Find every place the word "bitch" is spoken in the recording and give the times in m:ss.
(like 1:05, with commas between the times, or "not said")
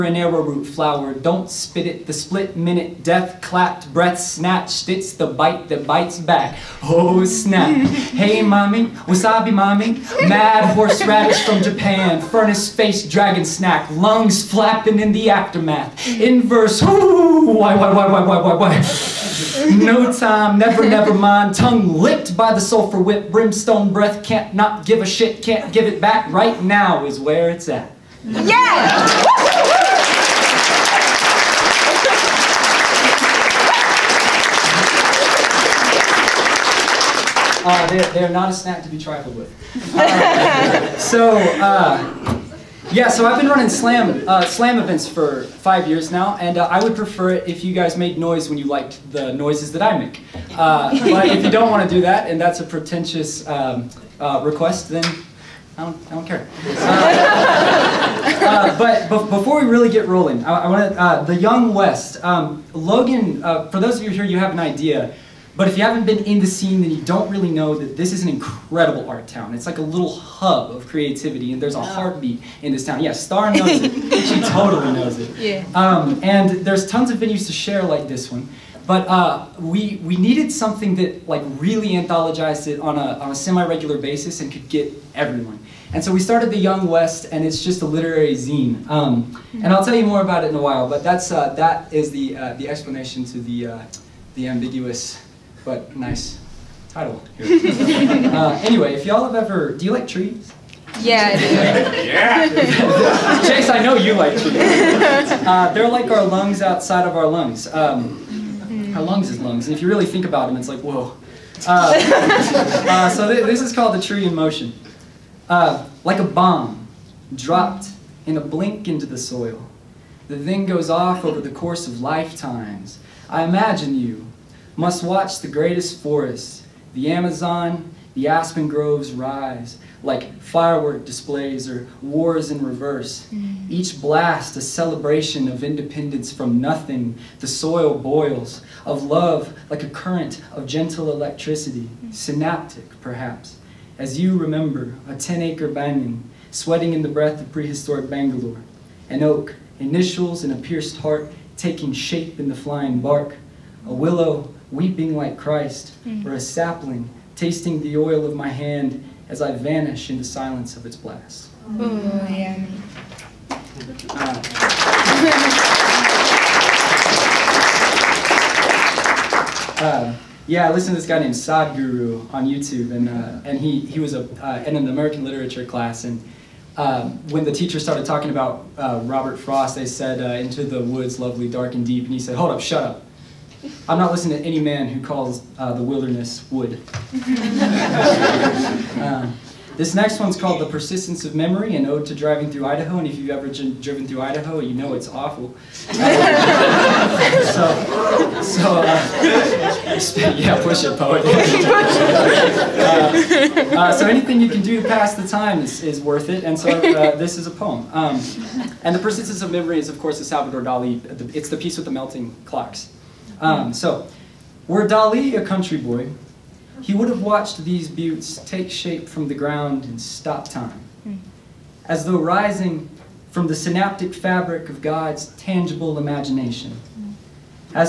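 not said.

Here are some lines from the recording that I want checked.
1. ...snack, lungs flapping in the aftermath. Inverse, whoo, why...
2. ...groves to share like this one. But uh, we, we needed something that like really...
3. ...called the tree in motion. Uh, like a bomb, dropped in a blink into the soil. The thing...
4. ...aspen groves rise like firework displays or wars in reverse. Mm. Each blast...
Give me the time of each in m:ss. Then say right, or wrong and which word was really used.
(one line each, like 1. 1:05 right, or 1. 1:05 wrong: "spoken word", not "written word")
1. 0:13 right
2. 1:17 wrong: "venues", not "groves"
3. 1:53 right
4. 2:08 right.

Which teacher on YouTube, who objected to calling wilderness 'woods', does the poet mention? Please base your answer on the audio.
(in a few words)
Sadhguru.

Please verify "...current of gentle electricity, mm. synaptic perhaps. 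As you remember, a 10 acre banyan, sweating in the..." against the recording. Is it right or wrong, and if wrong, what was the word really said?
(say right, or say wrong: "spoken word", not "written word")
right.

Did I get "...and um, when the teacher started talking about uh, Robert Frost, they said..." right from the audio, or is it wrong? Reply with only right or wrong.
right.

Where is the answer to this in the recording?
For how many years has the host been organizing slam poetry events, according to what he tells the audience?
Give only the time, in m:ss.
0:45.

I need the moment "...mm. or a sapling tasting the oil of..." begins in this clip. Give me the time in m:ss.
2:36.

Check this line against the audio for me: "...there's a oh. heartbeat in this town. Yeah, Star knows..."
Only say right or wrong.
right.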